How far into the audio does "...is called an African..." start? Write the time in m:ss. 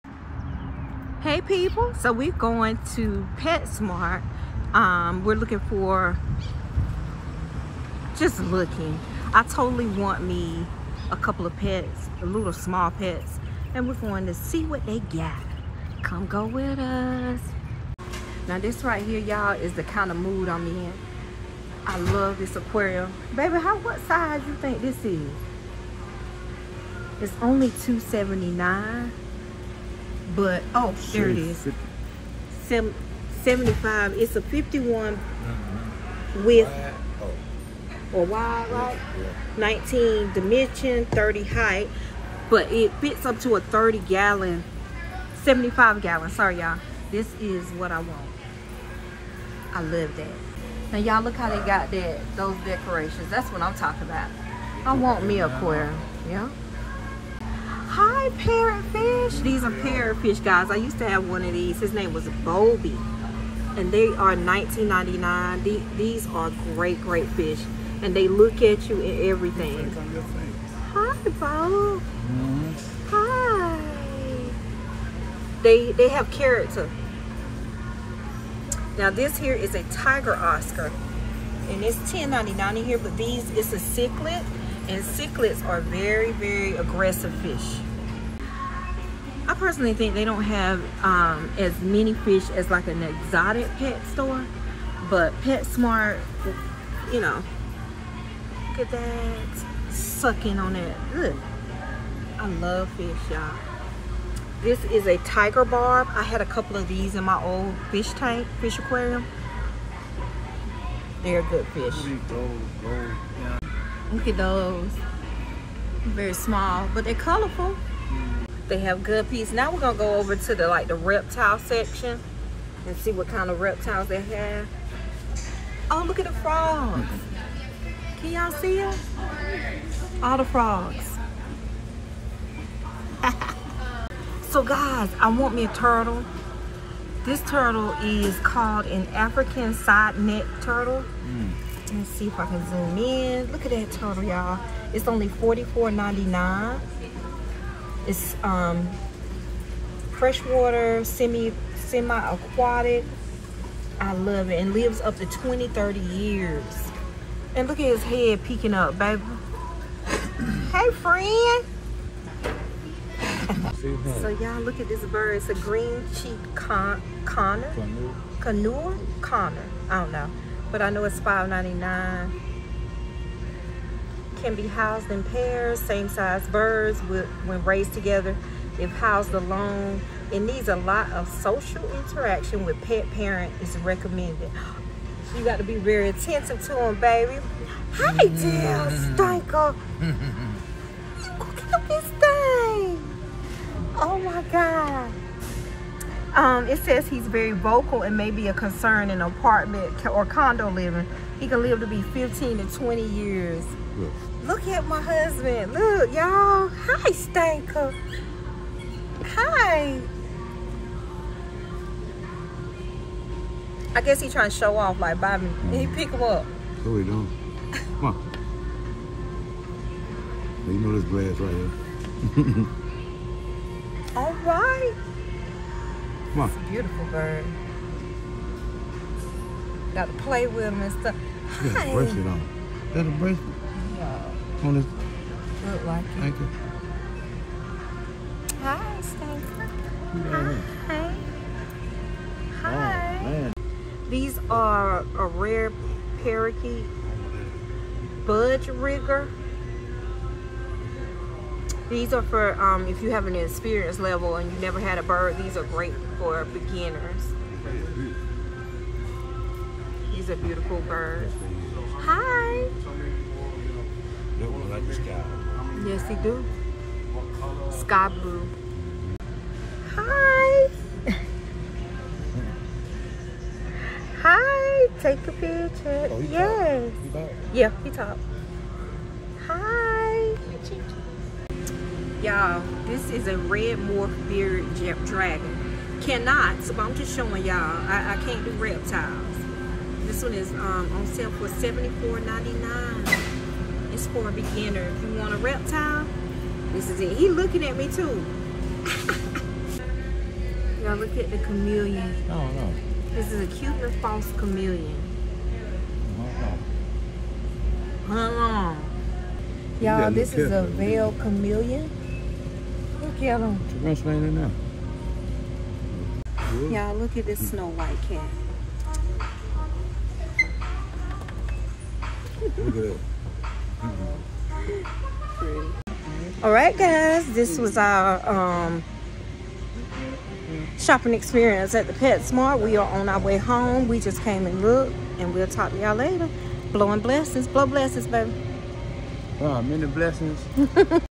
2:18.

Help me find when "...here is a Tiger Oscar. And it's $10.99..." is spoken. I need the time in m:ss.
1:19.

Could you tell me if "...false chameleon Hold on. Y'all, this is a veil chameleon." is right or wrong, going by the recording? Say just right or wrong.
right.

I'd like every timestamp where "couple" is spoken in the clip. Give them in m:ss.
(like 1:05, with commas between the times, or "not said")
0:11, 1:46.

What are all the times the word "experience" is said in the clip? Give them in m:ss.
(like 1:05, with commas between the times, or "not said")
4:13, 5:31.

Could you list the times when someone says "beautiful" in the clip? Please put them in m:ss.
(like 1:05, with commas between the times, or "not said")
3:46, 4:20.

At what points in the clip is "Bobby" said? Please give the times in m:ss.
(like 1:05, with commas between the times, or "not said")
1:02, 3:35.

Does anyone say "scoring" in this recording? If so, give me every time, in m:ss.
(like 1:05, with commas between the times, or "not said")
not said.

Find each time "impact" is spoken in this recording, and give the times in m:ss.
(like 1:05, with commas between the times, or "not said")
not said.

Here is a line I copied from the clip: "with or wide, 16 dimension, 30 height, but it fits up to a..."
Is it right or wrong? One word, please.
wrong.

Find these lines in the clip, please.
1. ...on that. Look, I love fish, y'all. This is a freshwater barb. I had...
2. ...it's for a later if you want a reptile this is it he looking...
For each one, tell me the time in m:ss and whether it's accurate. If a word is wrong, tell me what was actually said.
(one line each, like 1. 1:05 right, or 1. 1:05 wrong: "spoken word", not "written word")
1. 1:40 wrong: "tiger", not "freshwater"
2. 4:53 wrong: "beginner", not "later".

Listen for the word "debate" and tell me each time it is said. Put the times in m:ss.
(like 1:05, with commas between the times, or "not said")
not said.